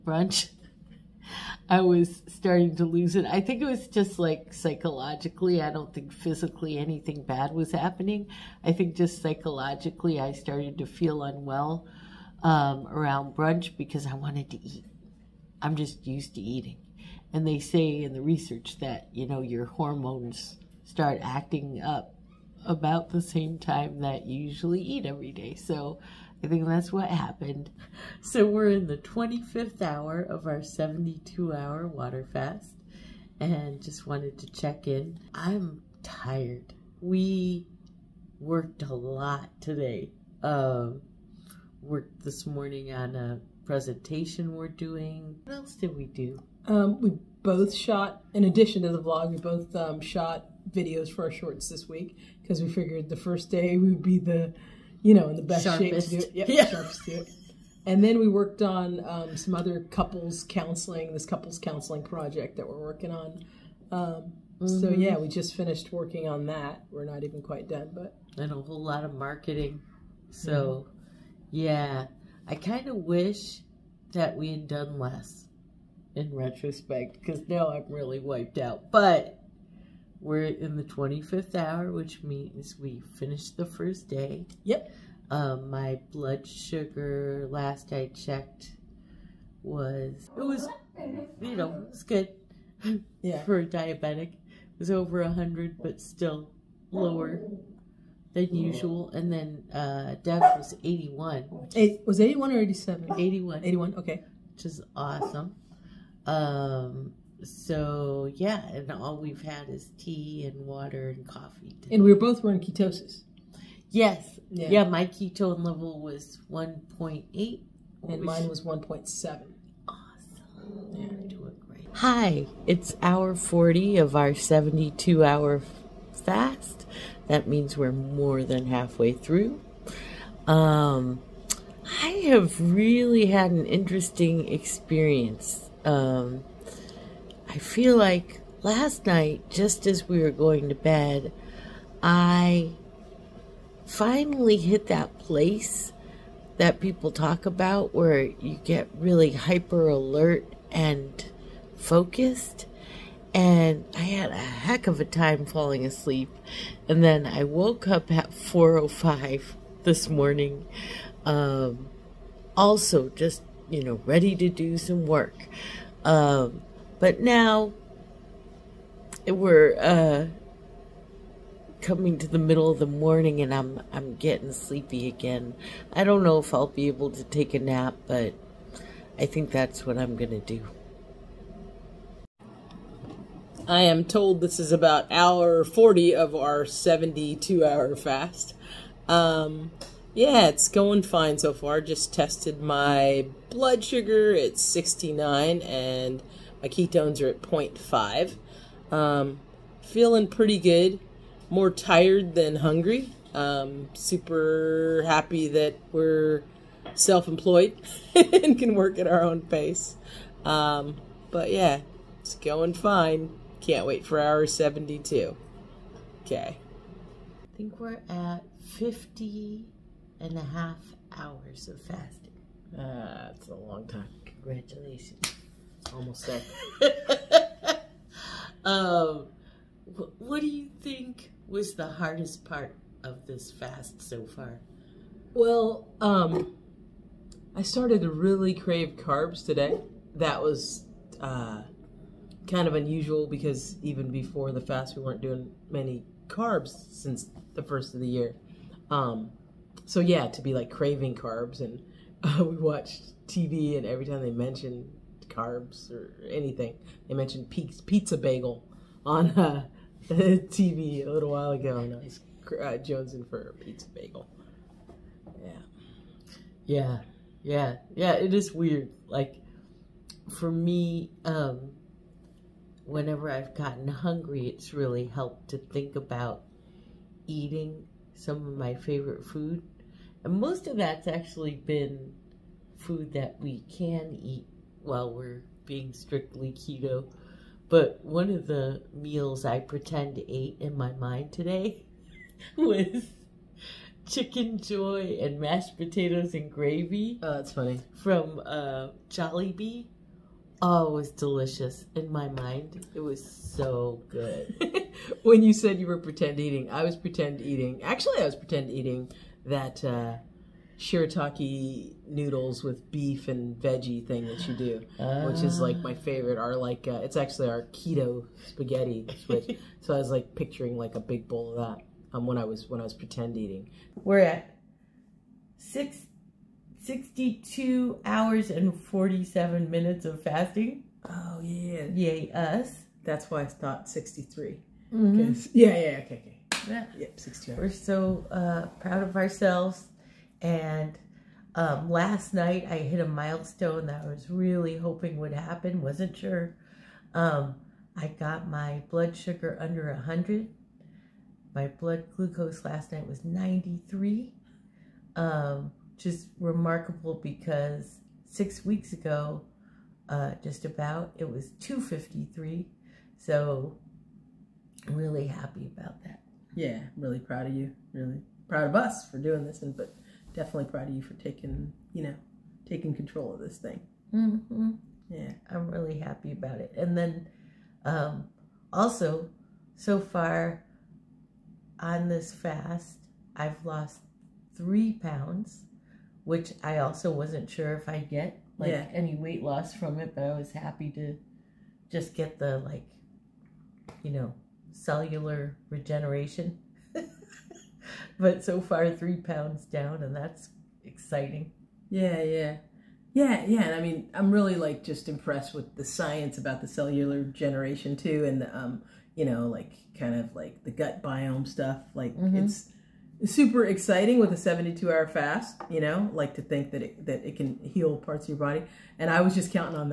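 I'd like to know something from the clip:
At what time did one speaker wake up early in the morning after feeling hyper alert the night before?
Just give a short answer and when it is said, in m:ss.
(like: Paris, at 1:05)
4:05, at 2:38.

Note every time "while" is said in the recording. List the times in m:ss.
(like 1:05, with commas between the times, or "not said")
4:21, 4:44.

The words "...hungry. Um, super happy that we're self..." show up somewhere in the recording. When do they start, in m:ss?
3:22.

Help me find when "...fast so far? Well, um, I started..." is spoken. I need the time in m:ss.
3:53.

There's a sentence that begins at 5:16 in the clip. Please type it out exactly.
Are like uh, it's actually our keto spaghetti switch.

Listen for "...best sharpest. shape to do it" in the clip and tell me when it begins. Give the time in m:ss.
0:55.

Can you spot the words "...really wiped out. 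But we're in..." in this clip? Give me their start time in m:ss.
1:17.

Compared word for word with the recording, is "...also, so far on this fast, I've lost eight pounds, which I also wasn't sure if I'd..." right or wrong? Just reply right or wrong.
wrong.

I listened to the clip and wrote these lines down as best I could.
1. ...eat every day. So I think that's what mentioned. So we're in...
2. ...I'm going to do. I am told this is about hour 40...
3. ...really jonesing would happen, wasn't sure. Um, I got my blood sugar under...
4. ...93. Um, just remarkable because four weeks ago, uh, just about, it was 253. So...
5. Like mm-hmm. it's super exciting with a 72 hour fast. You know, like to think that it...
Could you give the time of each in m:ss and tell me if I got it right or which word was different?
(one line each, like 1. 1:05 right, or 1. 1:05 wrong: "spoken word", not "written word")
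1. 0:24 wrong: "happened", not "mentioned"
2. 2:59 right
3. 5:44 wrong: "hoping", not "jonesing"
4. 5:53 wrong: "six", not "four"
5. 6:51 right.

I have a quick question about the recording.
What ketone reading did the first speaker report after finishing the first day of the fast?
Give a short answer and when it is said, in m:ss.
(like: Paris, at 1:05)
1.8, at 1:56.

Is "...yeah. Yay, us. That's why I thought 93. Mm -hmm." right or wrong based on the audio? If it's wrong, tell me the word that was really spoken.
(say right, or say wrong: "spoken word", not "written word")
wrong: "63", not "93".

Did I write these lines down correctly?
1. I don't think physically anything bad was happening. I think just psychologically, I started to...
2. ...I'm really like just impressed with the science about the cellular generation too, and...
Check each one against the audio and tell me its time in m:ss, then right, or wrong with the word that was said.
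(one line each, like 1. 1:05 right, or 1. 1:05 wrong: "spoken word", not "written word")
1. 0:05 right
2. 6:44 right.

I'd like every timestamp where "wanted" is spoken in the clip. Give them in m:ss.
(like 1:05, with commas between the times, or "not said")
0:14, 0:34.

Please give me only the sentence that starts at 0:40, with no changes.
Um, worked this morning on a presentation we're doing.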